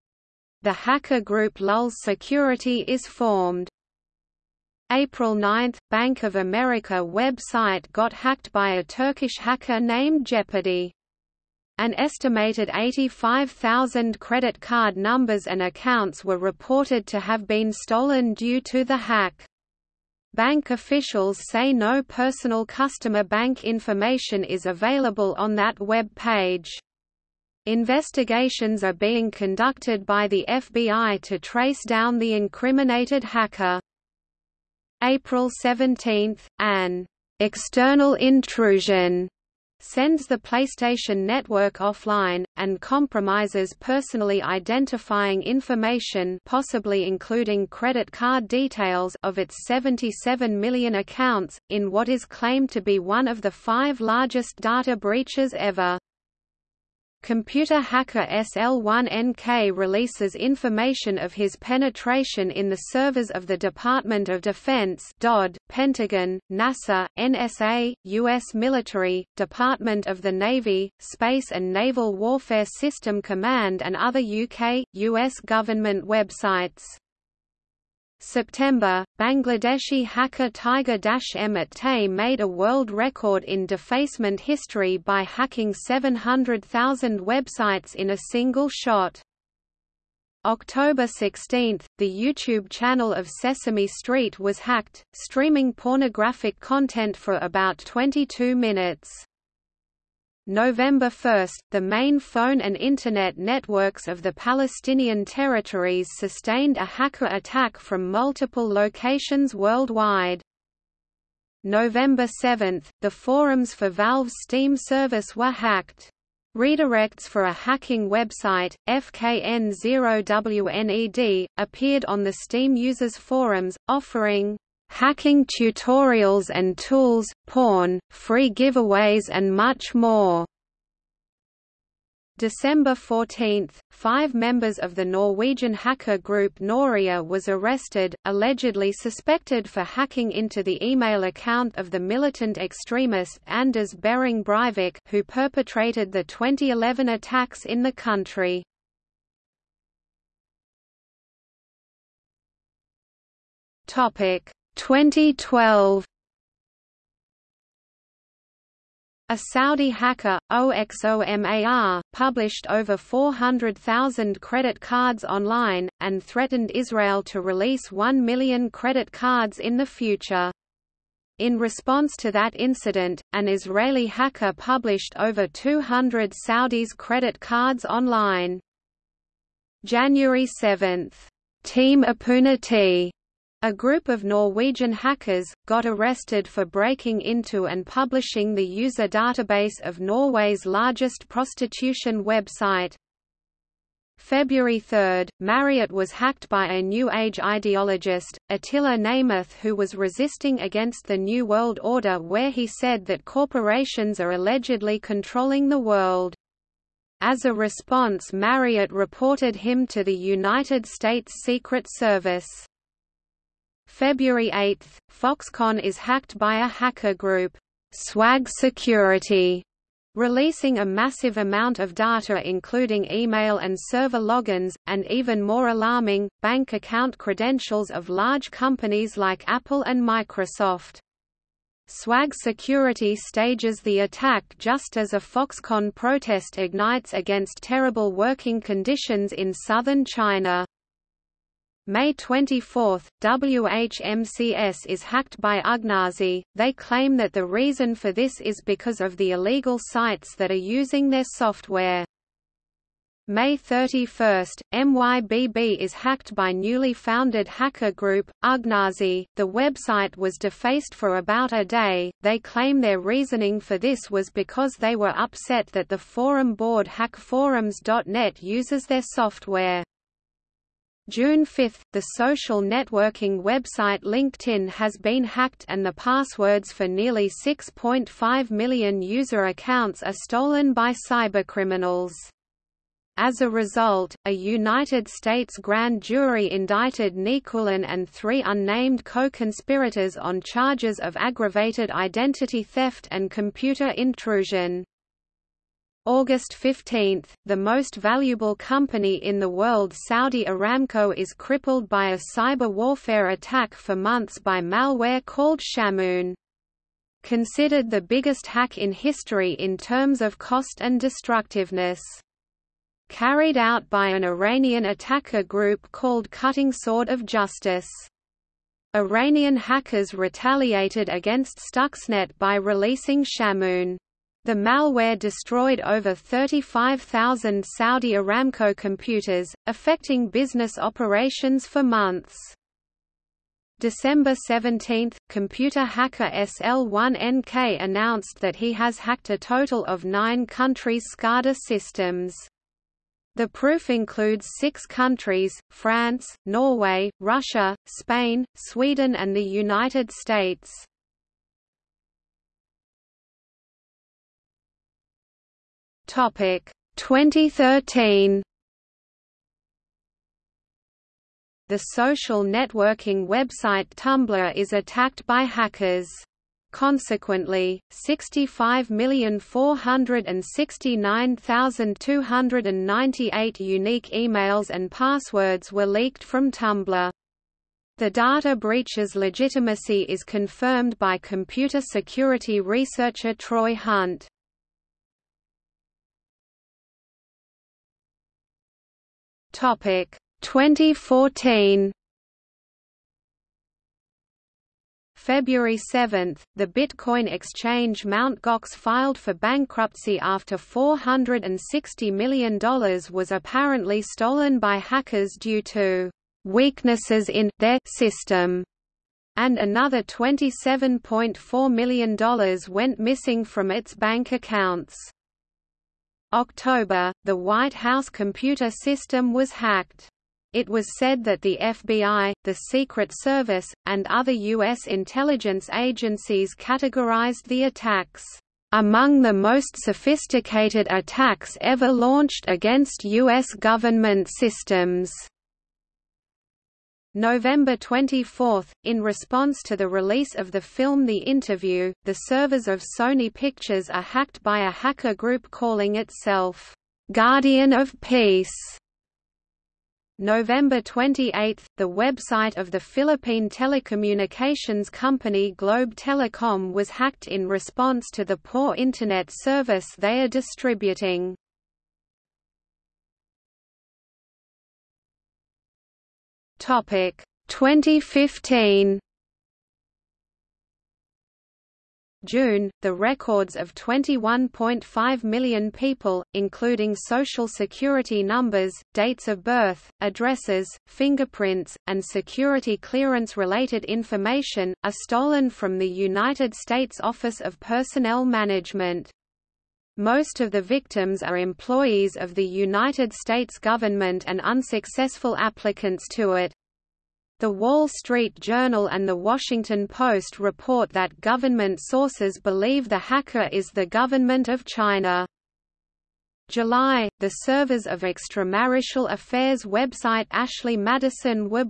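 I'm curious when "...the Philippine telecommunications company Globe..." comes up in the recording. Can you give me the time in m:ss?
7:32.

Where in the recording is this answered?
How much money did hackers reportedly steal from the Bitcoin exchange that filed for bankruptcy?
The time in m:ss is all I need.
6:40.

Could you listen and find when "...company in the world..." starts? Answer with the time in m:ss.
4:58.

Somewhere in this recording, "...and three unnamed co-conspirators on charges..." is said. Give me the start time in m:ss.
4:47.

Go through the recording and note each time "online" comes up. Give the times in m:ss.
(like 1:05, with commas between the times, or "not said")
2:45, 2:57.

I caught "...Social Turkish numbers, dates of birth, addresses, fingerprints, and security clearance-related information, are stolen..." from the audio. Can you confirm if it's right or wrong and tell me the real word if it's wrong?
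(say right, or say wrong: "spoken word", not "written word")
wrong: "Security", not "Turkish".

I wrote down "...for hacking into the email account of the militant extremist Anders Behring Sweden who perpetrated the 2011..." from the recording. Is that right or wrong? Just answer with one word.
wrong.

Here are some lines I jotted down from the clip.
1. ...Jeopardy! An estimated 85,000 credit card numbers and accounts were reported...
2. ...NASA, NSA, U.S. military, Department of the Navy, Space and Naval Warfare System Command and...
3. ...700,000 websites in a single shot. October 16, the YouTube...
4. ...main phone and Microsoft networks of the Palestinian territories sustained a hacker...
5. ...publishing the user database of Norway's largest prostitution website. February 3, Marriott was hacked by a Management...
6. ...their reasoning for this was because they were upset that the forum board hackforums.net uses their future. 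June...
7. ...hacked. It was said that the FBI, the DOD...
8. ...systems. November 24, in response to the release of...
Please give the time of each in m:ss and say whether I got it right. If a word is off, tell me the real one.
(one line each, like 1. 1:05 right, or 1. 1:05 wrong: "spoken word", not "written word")
1. 0:10 right
2. 1:06 right
3. 1:25 right
4. 1:41 wrong: "Internet", not "Microsoft"
5. 3:07 wrong: "New", not "Management"
6. 4:22 wrong: "software", not "future"
7. 6:59 wrong: "Secret", not "DOD"
8. 7:14 right.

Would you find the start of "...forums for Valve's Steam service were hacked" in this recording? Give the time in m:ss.
1:53.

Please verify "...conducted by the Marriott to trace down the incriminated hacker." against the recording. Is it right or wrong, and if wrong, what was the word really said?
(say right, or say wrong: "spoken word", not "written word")
wrong: "FBI", not "Marriott".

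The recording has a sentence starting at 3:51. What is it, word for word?
Swag Security stages the attack just as a Foxconn protest ignites against terrible working conditions in southern China.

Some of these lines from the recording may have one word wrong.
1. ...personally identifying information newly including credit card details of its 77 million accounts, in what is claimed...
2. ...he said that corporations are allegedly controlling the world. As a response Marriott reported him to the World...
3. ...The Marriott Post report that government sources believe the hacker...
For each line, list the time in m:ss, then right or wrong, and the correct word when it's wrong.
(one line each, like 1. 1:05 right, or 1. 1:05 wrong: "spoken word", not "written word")
1. 0:43 wrong: "possibly", not "newly"
2. 3:22 wrong: "United", not "World"
3. 8:19 wrong: "Washington", not "Marriott".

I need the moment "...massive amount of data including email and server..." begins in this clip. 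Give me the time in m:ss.
3:40.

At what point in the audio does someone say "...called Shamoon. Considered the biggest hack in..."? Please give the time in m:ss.
5:05.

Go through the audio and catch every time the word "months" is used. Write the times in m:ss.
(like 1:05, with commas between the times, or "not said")
5:03, 5:31.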